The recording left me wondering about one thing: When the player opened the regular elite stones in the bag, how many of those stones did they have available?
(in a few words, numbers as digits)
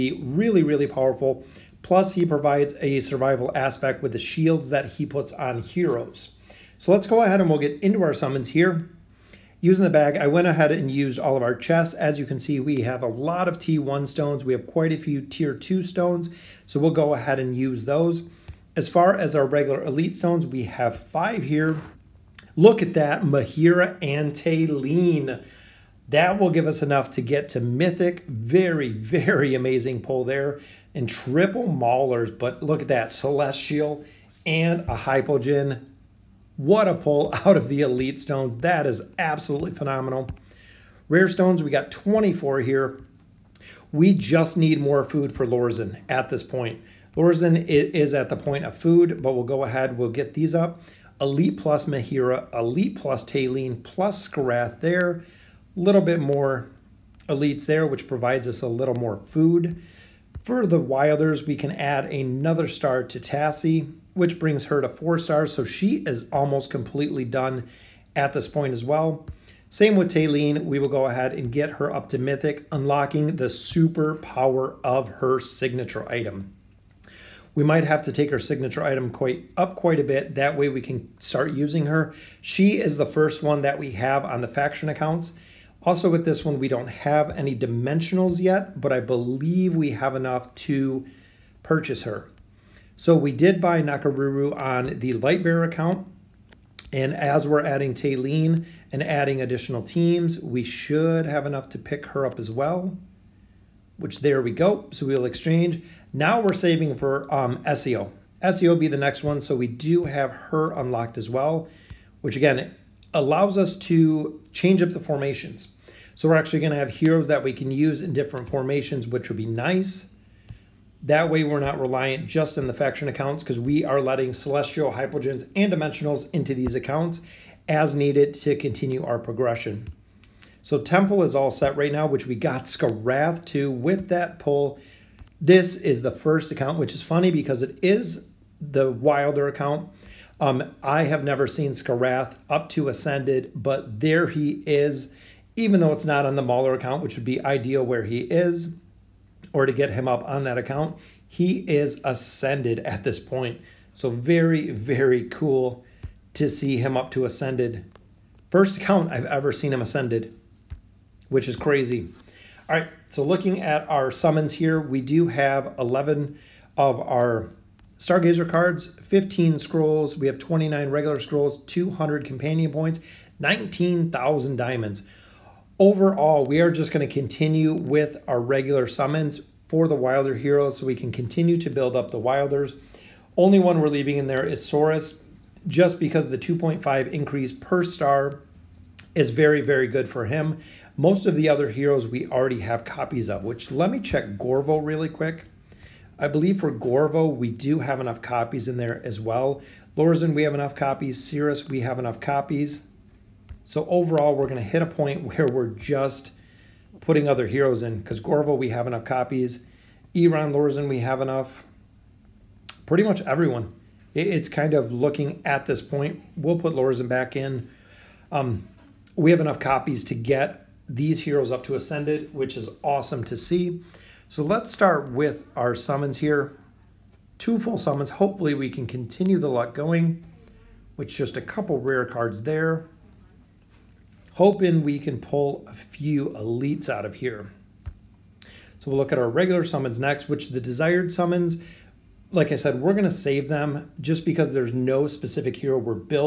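5.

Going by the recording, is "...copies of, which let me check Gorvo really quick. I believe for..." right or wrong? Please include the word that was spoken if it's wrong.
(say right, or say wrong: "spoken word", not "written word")
right.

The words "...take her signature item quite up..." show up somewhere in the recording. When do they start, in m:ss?
1:18.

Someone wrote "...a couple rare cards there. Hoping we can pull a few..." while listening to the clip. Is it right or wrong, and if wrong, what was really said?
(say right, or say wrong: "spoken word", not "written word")
right.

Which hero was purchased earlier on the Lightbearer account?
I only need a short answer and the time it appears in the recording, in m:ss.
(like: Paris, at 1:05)
Nakoruru, at 1:33.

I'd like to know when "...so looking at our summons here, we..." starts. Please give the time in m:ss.
2:43.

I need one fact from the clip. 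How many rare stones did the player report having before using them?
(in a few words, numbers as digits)
24.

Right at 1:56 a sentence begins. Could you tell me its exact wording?
So we're actually going to have heroes that we can use in different formations, which would be nice.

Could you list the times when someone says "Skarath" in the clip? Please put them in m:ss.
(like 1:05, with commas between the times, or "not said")
0:54, 2:12.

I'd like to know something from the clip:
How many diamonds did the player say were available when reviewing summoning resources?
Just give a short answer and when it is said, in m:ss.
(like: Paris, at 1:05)
19,000, at 2:53.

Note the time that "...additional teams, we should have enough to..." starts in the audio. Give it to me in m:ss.
1:39.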